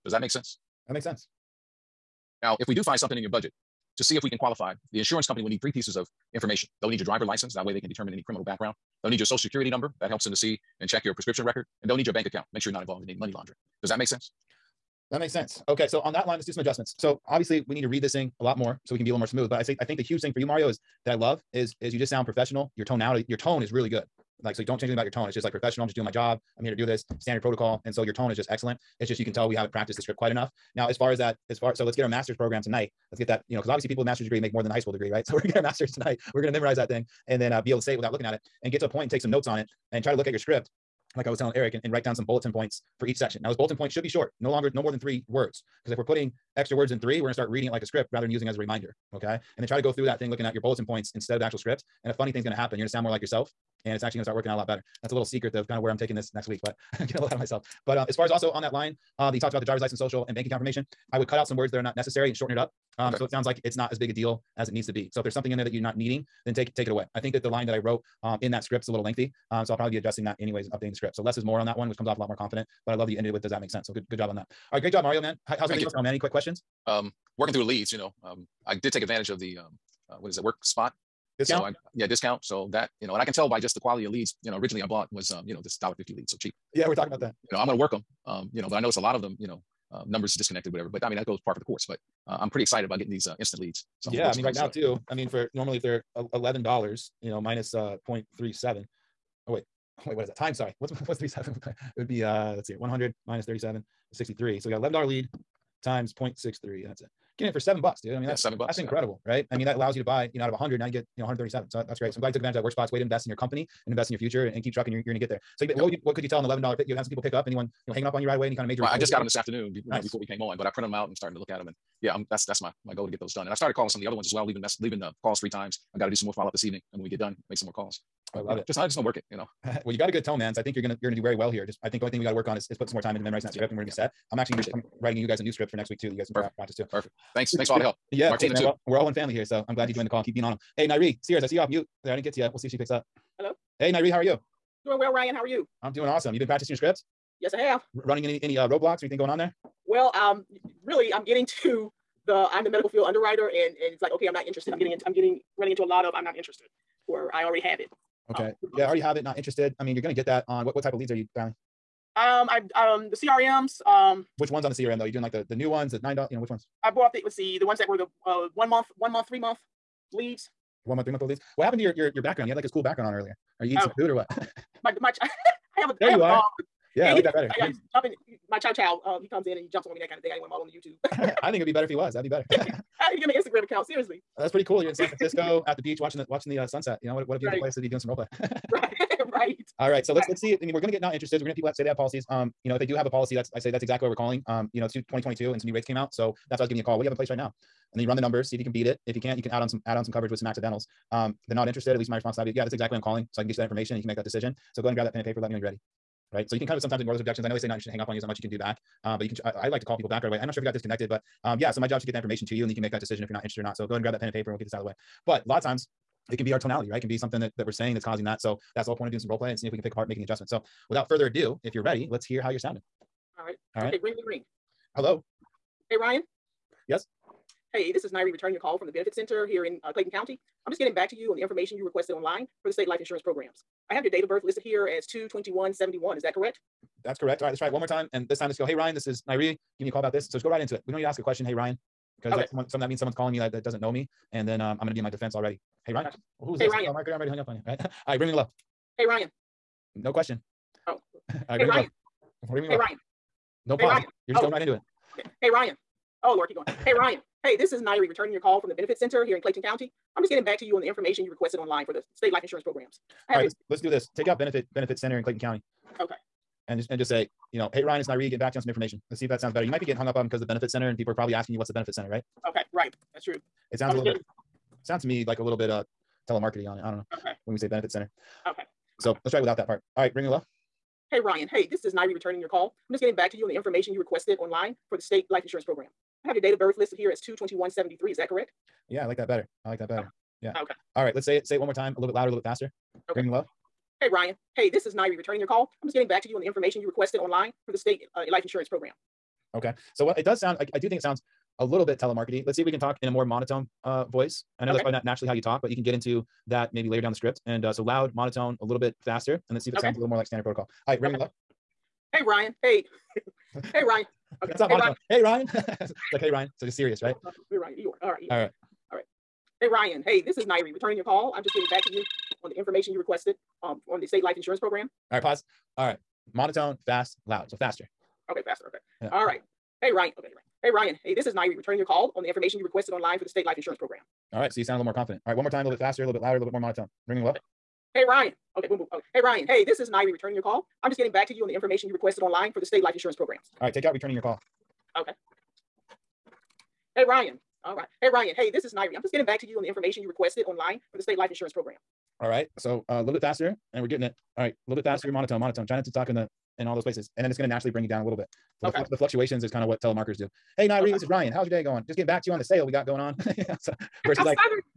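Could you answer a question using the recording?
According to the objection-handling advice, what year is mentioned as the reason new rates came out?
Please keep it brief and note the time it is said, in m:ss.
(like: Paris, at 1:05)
2022, at 3:14.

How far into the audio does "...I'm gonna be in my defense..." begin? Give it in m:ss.
4:04.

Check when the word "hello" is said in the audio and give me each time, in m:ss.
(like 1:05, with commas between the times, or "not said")
2:23, 3:44, 4:40.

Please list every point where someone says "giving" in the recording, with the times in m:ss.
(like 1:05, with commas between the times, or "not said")
3:16, 3:59.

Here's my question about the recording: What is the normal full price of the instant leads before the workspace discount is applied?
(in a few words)
$11.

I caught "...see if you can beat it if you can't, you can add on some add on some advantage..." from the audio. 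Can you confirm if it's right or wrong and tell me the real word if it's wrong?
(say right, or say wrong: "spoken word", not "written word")
wrong: "coverage", not "advantage".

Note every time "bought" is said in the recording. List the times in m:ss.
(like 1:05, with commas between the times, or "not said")
1:24, 2:46.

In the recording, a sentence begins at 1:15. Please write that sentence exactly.
How, how's everything else going, man?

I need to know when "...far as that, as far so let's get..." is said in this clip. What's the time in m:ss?
0:30.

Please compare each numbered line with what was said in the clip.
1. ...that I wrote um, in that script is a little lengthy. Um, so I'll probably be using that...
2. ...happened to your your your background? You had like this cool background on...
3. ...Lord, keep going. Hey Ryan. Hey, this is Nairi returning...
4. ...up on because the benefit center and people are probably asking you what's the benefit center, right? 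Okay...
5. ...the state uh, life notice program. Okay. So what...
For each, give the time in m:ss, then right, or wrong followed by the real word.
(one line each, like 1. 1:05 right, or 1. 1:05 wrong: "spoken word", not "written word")
1. 1:07 wrong: "adjusting", not "using"
2. 2:51 right
3. 4:16 right
4. 4:30 right
5. 4:57 wrong: "insurance", not "notice".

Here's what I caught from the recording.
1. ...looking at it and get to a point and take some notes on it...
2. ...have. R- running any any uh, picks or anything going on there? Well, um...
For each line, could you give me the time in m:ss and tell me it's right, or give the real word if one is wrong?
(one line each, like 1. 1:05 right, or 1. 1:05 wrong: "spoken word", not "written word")
1. 0:38 right
2. 2:27 wrong: "roadblocks", not "picks".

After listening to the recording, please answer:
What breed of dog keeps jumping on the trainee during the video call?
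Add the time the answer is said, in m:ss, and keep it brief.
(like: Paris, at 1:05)
Chow chow, at 2:58.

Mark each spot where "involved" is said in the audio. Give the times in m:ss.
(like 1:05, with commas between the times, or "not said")
0:12.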